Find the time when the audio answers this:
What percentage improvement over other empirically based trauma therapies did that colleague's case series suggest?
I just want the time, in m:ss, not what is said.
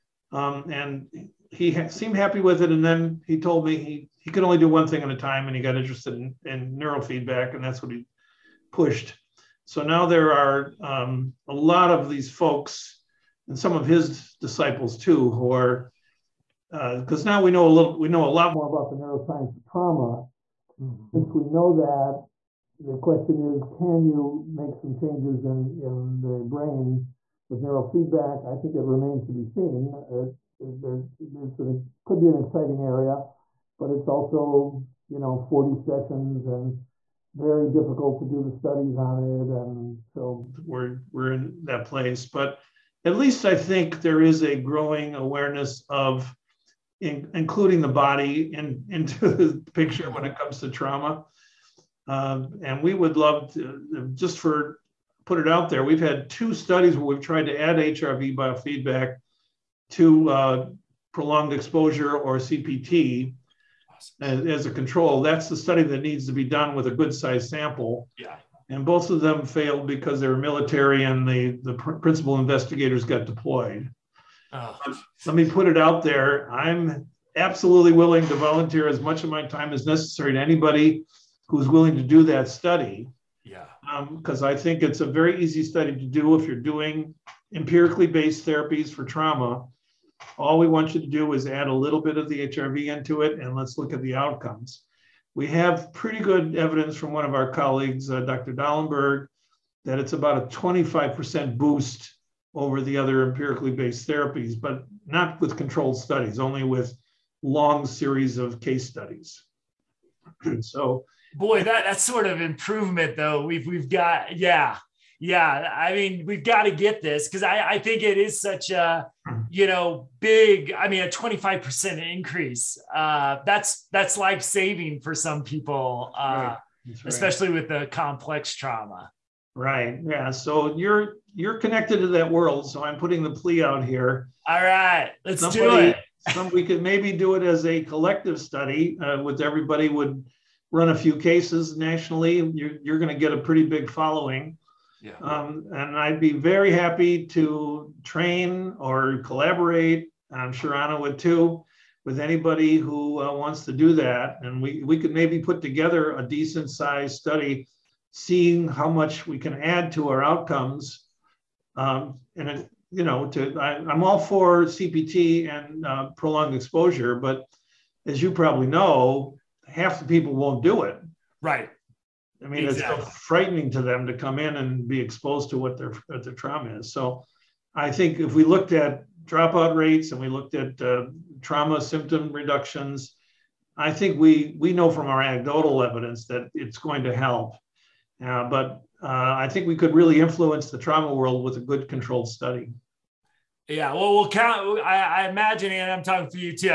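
1:40.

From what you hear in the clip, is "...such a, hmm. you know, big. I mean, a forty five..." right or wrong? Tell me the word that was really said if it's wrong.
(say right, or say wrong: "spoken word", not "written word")
wrong: "twenty", not "forty".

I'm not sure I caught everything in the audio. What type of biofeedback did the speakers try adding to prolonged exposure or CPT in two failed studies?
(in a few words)
HRV biofeedback.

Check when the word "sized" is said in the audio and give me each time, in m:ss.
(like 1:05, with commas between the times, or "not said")
1:07, 2:36.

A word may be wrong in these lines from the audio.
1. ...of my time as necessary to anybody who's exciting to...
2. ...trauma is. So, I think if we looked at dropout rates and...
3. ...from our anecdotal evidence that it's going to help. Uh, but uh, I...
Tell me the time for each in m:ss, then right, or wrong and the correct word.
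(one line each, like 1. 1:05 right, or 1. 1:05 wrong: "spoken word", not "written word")
1. 1:19 wrong: "willing", not "exciting"
2. 2:56 right
3. 3:04 right.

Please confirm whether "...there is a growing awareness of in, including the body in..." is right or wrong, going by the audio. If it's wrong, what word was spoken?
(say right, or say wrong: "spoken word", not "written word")
right.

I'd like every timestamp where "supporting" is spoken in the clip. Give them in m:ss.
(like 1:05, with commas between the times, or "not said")
not said.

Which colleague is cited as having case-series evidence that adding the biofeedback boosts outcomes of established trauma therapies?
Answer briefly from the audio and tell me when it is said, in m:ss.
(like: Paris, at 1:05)
Dr. Dallenberg, at 1:38.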